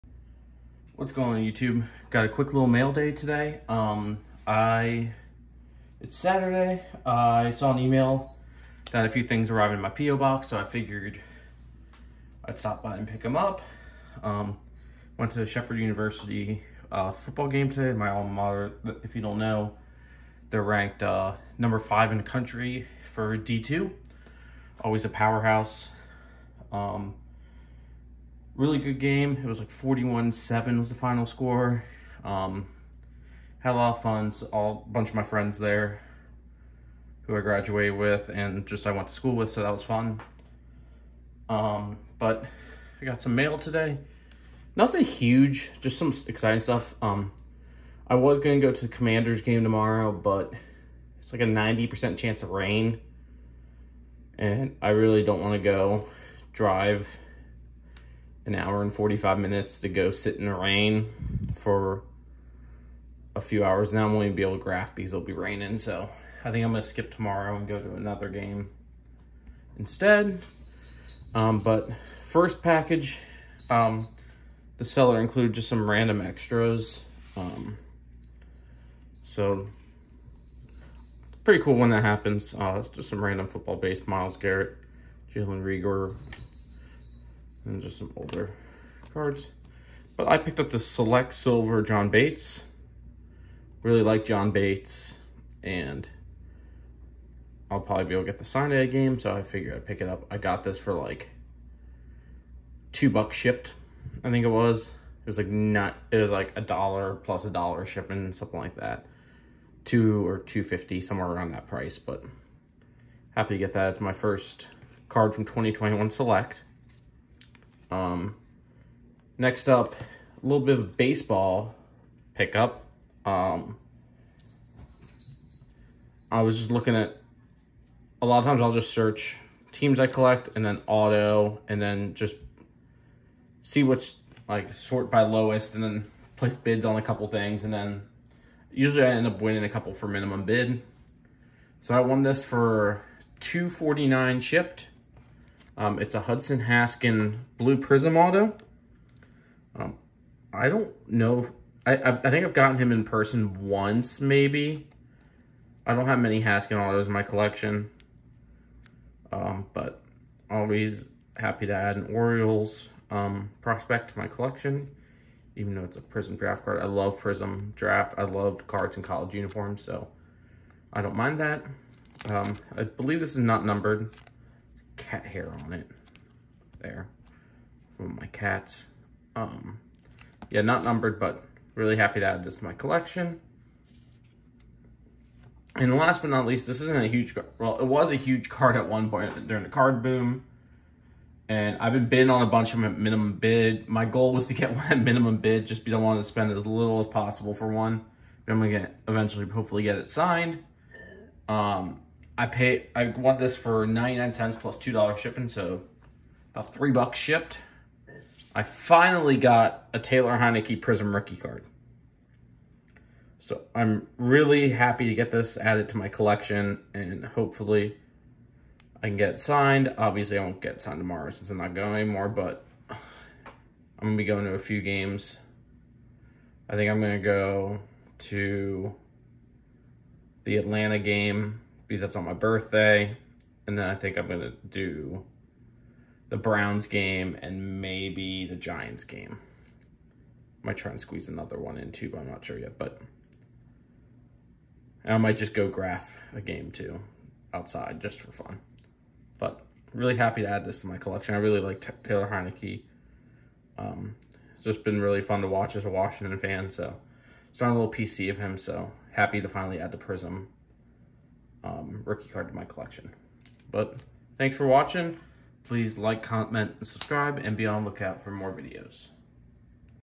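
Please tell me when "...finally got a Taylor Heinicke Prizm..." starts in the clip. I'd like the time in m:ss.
3:28.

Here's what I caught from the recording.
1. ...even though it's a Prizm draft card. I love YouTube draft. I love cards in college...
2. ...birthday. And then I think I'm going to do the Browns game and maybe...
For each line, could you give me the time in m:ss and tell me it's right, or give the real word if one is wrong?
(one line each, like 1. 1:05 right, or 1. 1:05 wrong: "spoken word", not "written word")
1. 2:45 wrong: "Prizm", not "YouTube"
2. 3:52 right.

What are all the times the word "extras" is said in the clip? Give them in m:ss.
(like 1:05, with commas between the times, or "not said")
1:16.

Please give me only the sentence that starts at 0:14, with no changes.
Um, went to the Shepherd University uh, football game today, my alma mater.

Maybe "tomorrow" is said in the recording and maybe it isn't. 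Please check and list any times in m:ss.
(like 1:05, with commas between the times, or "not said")
0:49, 1:07, 3:40.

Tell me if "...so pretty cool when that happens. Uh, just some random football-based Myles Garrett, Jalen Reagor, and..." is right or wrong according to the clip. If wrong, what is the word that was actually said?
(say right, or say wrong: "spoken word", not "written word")
right.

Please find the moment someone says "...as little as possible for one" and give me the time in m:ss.
3:16.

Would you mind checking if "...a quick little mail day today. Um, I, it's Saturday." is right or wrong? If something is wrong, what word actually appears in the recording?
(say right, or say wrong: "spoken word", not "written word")
right.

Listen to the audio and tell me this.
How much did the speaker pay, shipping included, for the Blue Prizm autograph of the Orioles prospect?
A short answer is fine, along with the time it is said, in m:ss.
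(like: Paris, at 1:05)
$2.49, at 2:23.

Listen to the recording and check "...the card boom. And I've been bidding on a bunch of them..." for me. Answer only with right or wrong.
right.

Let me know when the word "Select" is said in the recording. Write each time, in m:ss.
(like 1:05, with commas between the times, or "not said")
1:30, 1:56.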